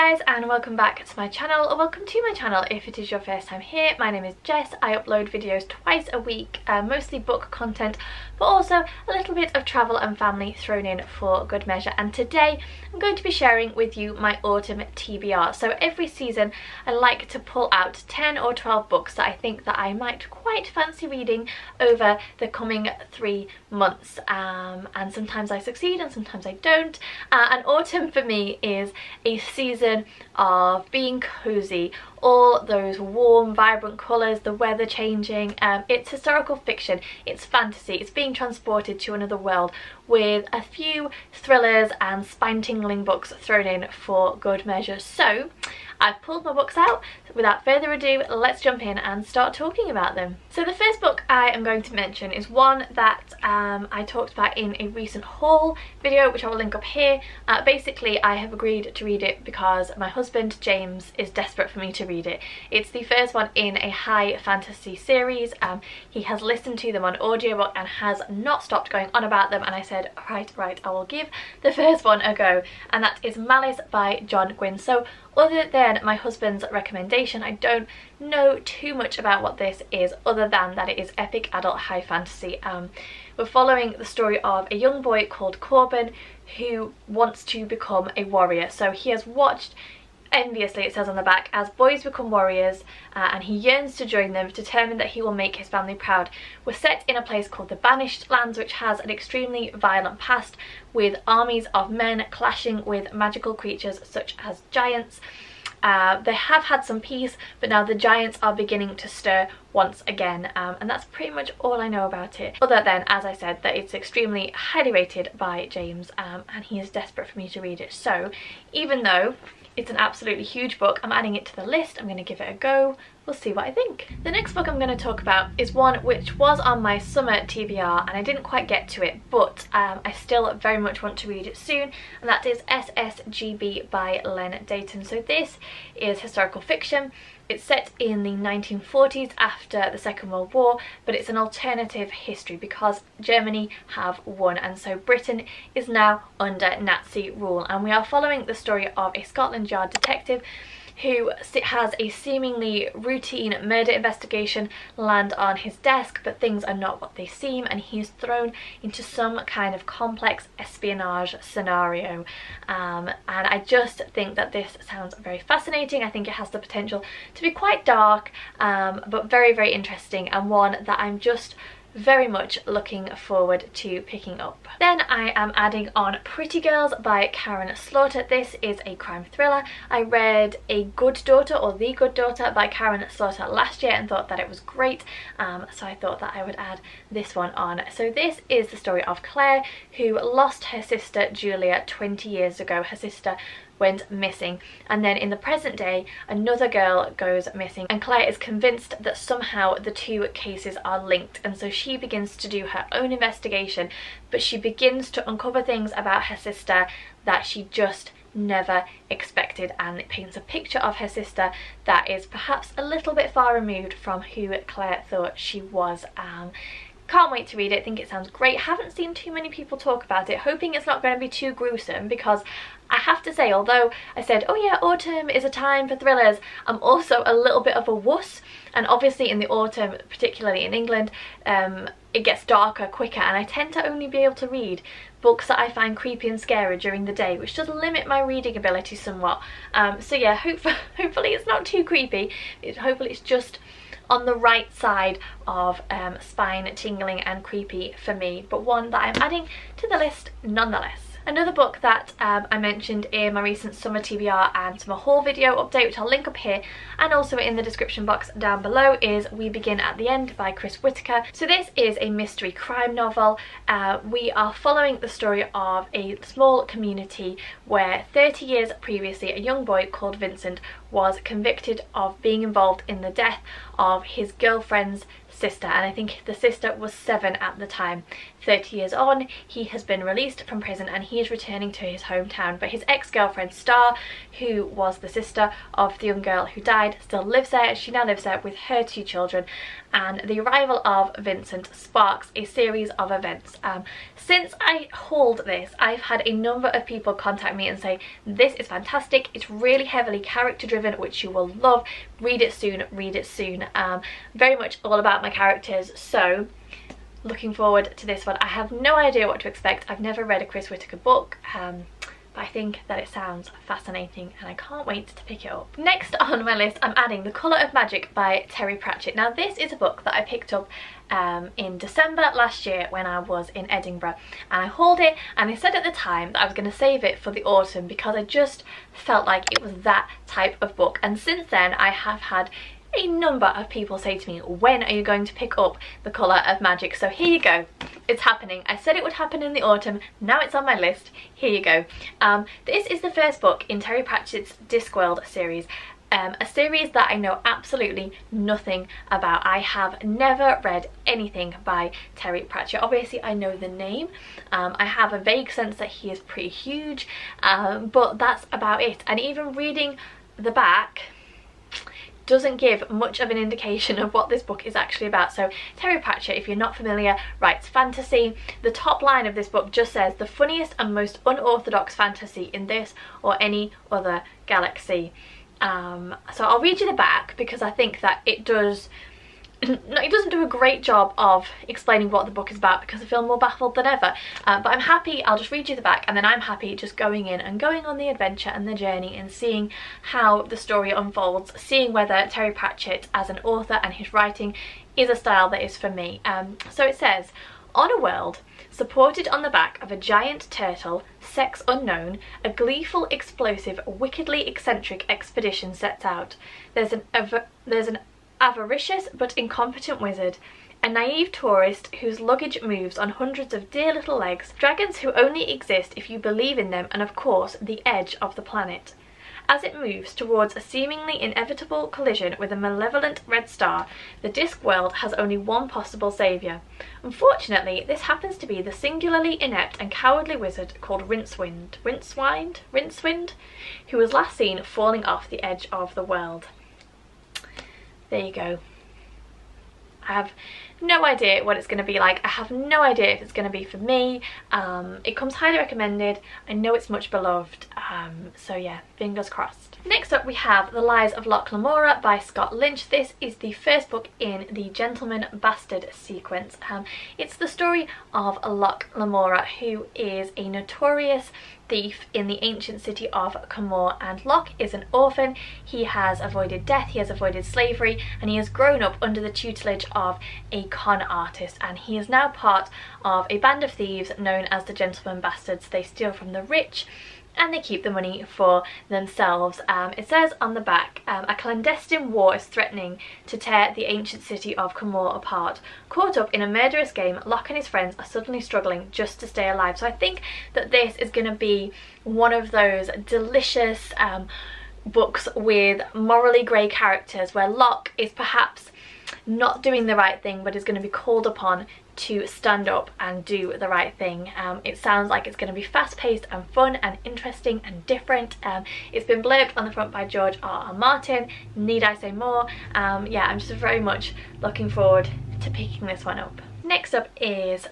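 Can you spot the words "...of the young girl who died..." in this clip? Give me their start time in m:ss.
4:45.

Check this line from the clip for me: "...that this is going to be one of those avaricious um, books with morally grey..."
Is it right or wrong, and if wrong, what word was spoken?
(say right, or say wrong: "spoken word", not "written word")
wrong: "delicious", not "avaricious".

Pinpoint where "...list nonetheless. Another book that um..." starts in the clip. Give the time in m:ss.
4:09.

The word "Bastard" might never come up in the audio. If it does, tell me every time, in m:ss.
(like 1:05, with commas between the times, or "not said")
7:35, 7:55.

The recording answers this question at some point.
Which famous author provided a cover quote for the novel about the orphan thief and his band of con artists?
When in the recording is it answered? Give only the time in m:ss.
8:30.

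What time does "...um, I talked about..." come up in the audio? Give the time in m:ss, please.
0:53.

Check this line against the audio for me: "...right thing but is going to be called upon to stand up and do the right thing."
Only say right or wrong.
right.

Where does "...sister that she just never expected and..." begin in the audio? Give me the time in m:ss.
3:26.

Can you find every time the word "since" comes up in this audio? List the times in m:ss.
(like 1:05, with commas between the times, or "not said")
4:54, 5:31.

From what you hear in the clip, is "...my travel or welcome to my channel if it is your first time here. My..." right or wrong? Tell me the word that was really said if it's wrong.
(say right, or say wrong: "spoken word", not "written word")
wrong: "channel", not "travel".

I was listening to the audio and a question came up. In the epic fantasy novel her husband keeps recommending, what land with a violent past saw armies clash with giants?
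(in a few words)
the Banished Lands.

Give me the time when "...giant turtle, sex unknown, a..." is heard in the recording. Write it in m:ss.
6:39.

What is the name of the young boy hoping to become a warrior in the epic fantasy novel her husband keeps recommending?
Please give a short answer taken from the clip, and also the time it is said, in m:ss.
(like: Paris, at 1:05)
Corban, at 1:25.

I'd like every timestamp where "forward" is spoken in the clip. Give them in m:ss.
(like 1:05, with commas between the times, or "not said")
2:53, 5:07, 8:34.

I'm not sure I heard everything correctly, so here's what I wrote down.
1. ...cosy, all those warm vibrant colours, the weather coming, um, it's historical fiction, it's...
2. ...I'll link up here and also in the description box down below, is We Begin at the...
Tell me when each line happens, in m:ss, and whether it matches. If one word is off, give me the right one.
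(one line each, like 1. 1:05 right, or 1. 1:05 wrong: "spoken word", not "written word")
1. 0:31 wrong: "changing", not "coming"
2. 4:15 right.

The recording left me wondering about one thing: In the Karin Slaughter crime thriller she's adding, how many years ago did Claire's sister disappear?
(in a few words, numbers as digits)
20.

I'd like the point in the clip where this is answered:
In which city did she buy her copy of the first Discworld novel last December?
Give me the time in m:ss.
5:23.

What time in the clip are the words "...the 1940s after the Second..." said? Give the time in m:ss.
2:18.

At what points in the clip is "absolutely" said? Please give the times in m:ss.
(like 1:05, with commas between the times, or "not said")
1:59, 5:47.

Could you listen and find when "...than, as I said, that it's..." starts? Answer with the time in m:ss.
1:52.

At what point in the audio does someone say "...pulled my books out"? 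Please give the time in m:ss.
0:46.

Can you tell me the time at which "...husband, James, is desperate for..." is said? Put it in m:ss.
1:00.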